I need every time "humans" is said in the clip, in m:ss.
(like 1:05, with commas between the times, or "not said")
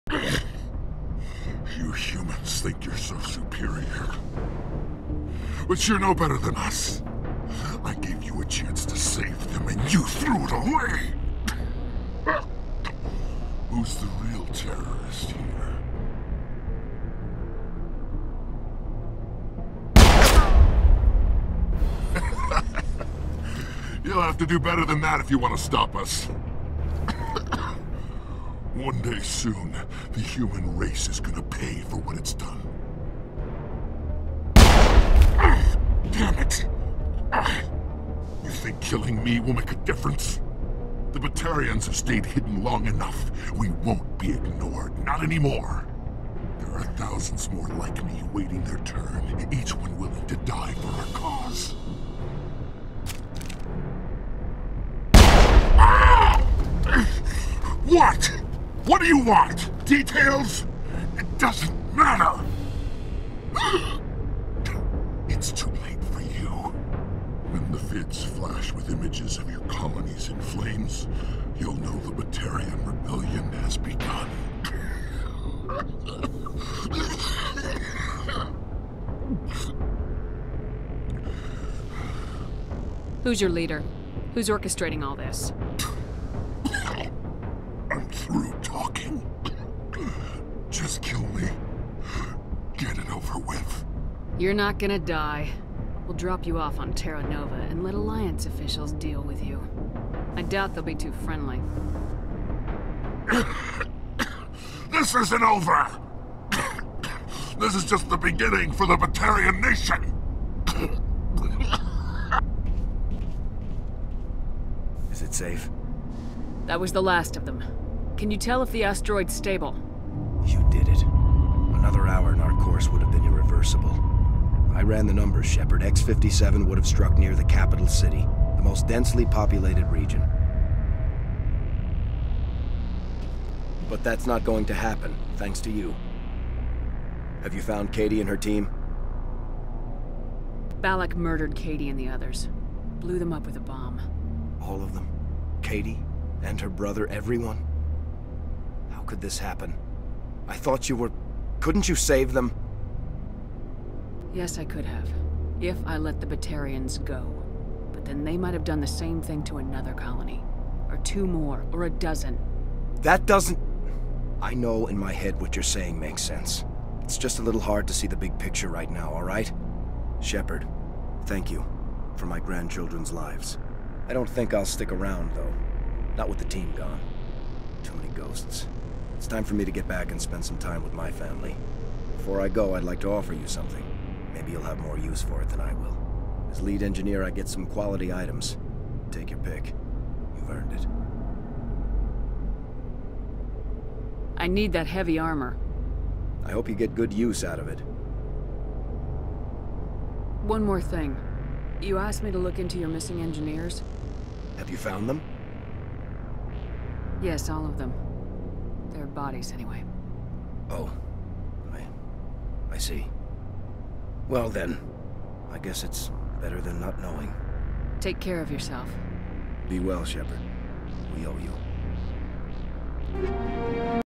0:01, 0:30.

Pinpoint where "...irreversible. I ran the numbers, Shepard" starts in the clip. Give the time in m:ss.
2:03.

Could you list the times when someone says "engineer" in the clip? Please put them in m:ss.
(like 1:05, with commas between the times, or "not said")
3:06, 3:23.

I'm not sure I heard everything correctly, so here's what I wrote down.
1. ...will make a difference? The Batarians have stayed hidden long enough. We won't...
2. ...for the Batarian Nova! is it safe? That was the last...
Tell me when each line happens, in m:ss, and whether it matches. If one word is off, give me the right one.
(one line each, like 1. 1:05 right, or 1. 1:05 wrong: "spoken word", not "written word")
1. 0:39 right
2. 1:48 wrong: "Nation", not "Nova".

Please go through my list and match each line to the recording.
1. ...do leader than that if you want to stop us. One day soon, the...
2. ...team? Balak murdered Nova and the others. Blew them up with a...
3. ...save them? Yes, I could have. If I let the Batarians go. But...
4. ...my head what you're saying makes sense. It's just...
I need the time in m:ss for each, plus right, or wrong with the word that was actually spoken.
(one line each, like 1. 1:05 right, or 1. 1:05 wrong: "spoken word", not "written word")
1. 0:24 wrong: "better", not "leader"
2. 2:18 wrong: "Katie", not "Nova"
3. 2:31 right
4. 2:44 right.